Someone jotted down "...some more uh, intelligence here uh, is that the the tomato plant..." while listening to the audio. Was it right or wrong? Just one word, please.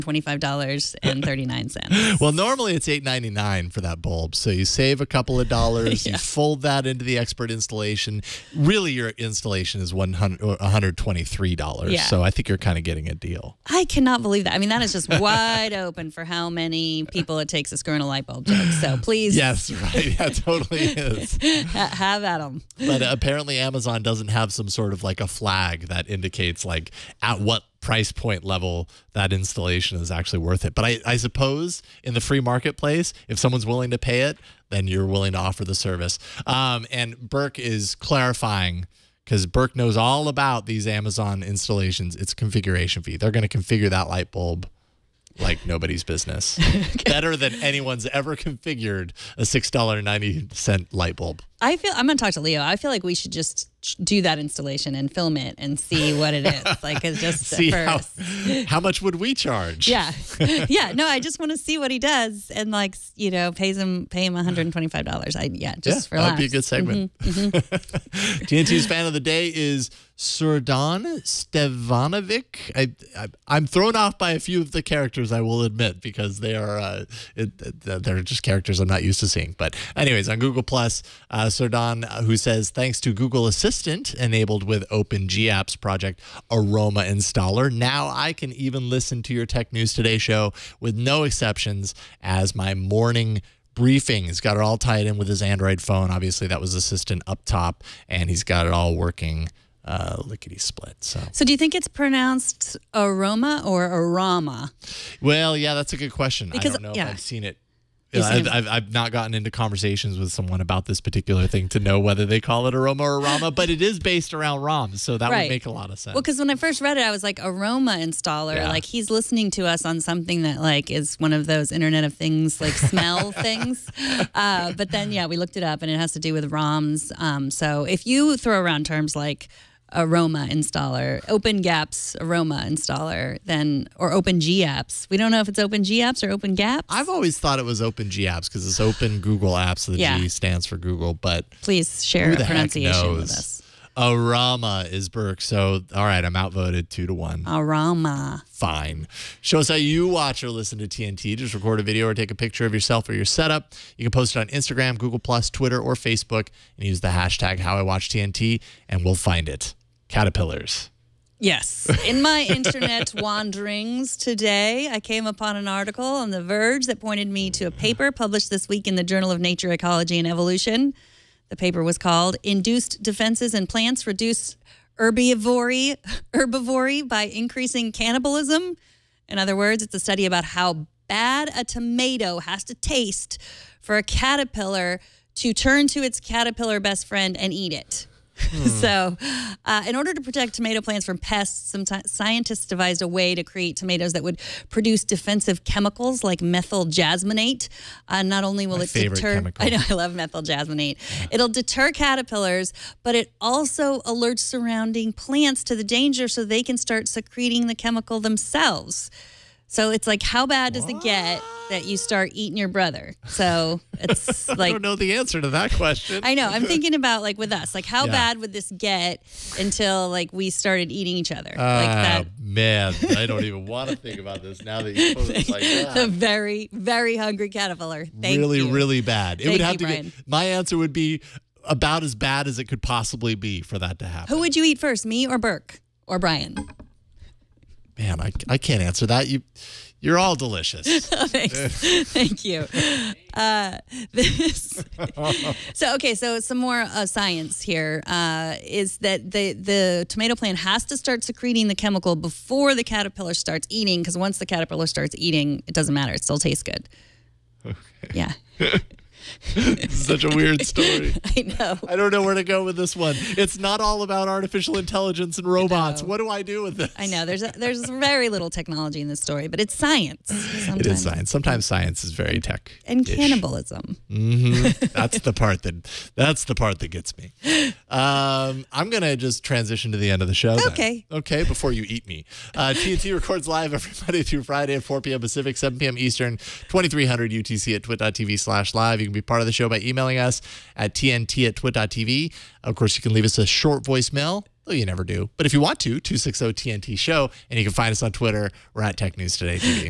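wrong.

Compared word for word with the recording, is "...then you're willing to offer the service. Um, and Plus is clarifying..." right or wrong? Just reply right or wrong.
wrong.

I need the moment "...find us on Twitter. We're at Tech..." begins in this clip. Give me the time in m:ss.
4:57.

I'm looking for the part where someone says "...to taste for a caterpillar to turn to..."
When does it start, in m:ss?
3:02.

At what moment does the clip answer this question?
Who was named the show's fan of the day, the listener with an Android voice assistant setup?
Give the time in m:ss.
1:10.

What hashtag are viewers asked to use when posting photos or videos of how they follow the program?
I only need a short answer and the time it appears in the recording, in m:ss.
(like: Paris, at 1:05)
HowIWatchTNT, at 2:37.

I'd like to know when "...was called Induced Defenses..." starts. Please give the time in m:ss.
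2:51.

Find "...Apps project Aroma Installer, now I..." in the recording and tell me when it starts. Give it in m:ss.
1:25.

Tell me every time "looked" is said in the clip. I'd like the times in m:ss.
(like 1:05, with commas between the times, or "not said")
2:05.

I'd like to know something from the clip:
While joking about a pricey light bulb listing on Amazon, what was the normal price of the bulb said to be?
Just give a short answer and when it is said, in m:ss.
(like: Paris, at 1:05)
$8.99, at 0:02.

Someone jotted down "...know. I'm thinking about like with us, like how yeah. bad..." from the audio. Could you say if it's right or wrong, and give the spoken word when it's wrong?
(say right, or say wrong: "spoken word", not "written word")
right.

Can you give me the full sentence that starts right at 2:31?
Just record a video or take a picture of yourself or your setup.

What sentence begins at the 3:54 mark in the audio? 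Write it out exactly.
Who would you eat first, me or Burke or Brian?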